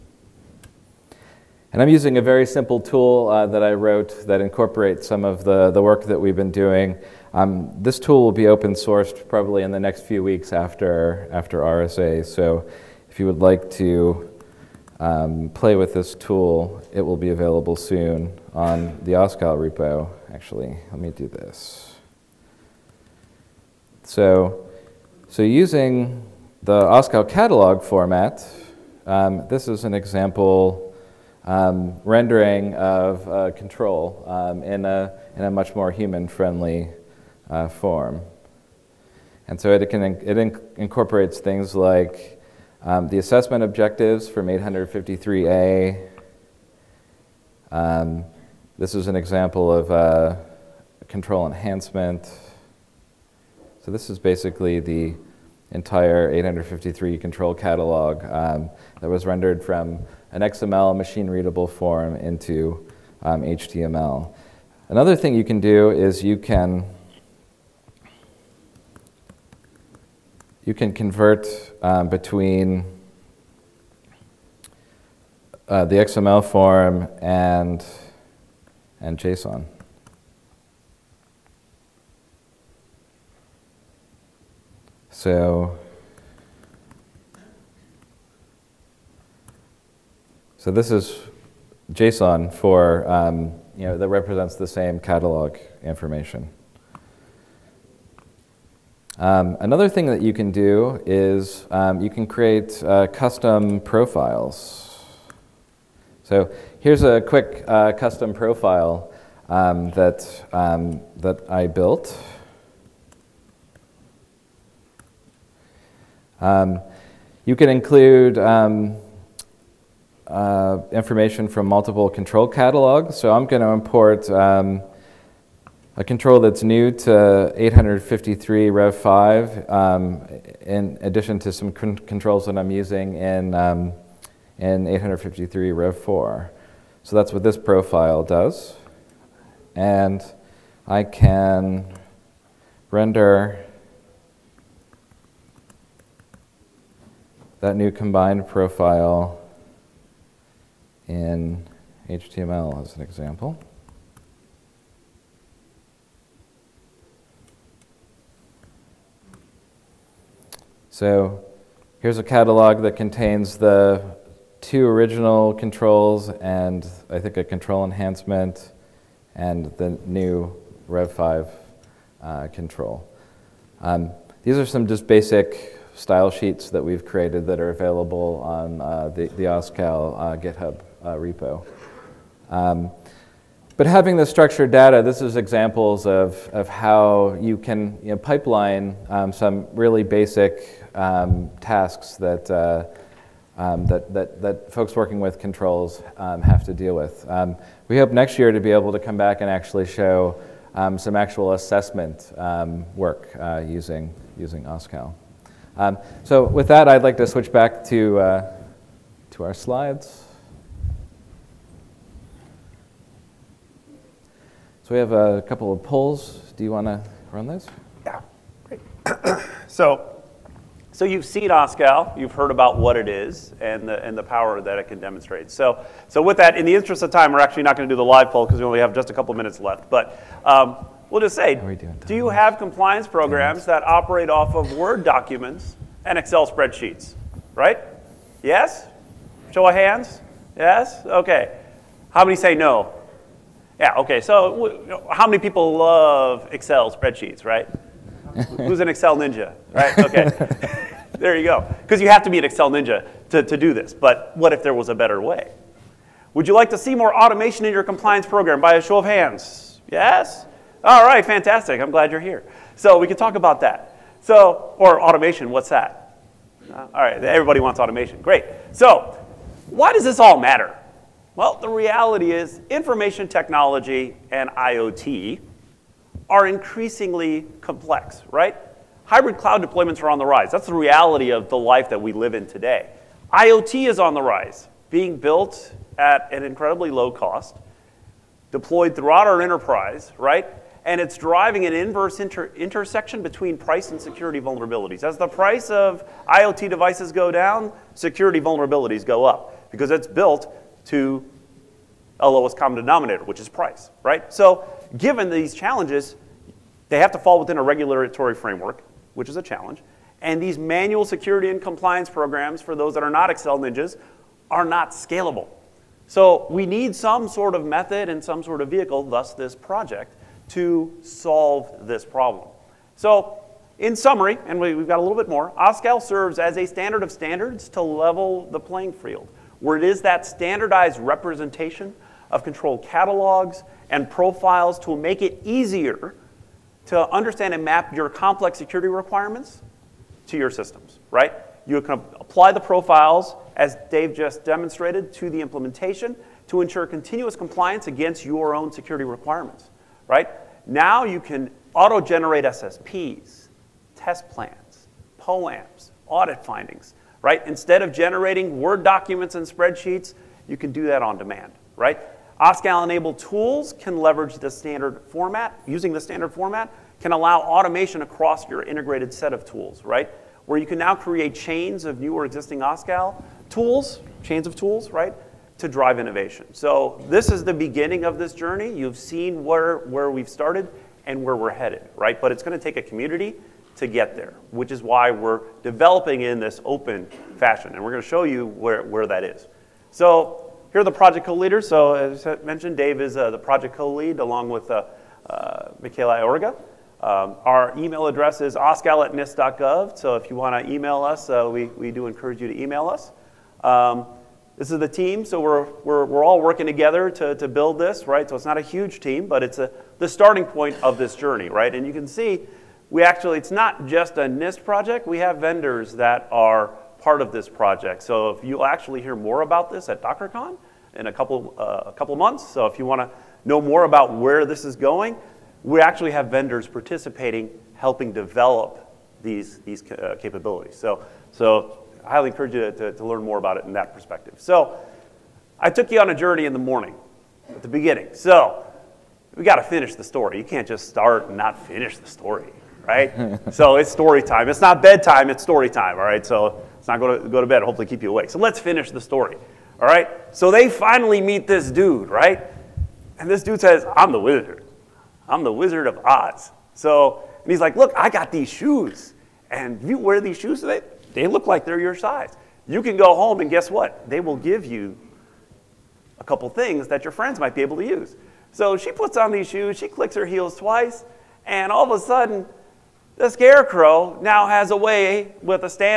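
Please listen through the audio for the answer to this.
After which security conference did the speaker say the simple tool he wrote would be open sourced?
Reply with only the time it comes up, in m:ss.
0:11.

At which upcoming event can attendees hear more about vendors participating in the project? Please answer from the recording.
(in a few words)
DockerCon.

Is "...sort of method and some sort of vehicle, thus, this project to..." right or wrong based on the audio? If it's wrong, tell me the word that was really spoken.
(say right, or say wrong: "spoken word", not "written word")
right.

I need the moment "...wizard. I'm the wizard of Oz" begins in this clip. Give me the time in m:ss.
7:34.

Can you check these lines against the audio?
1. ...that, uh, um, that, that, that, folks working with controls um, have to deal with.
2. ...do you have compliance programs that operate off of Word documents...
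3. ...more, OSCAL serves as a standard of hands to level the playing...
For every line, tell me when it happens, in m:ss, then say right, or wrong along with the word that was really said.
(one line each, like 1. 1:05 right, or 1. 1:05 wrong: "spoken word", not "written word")
1. 3:12 right
2. 3:52 right
3. 5:25 wrong: "standards", not "hands".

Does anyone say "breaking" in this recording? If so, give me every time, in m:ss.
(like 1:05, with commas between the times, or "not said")
not said.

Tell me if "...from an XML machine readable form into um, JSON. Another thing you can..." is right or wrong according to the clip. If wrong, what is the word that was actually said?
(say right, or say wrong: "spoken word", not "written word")
wrong: "HTML", not "JSON".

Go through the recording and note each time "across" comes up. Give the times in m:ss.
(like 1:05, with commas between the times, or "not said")
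6:08.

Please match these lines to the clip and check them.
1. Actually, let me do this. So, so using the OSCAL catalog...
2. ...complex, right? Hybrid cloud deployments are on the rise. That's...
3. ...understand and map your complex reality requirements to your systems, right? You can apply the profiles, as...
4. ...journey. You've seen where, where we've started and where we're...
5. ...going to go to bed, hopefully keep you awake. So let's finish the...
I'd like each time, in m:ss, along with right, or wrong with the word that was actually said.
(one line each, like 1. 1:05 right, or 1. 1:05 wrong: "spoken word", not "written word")
1. 0:20 right
2. 4:37 right
3. 5:37 wrong: "security", not "reality"
4. 6:18 right
5. 7:26 right.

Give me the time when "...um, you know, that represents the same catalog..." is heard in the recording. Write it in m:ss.
1:33.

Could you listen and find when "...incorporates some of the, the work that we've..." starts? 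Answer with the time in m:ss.
0:04.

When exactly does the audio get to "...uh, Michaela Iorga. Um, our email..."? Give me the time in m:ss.
6:35.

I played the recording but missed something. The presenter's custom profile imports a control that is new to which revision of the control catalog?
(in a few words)
853 Rev 5.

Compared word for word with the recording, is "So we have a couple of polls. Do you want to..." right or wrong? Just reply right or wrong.
right.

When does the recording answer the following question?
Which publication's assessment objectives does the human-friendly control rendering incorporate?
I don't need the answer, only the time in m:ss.
0:44.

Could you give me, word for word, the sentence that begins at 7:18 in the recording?
So we got to finish the story.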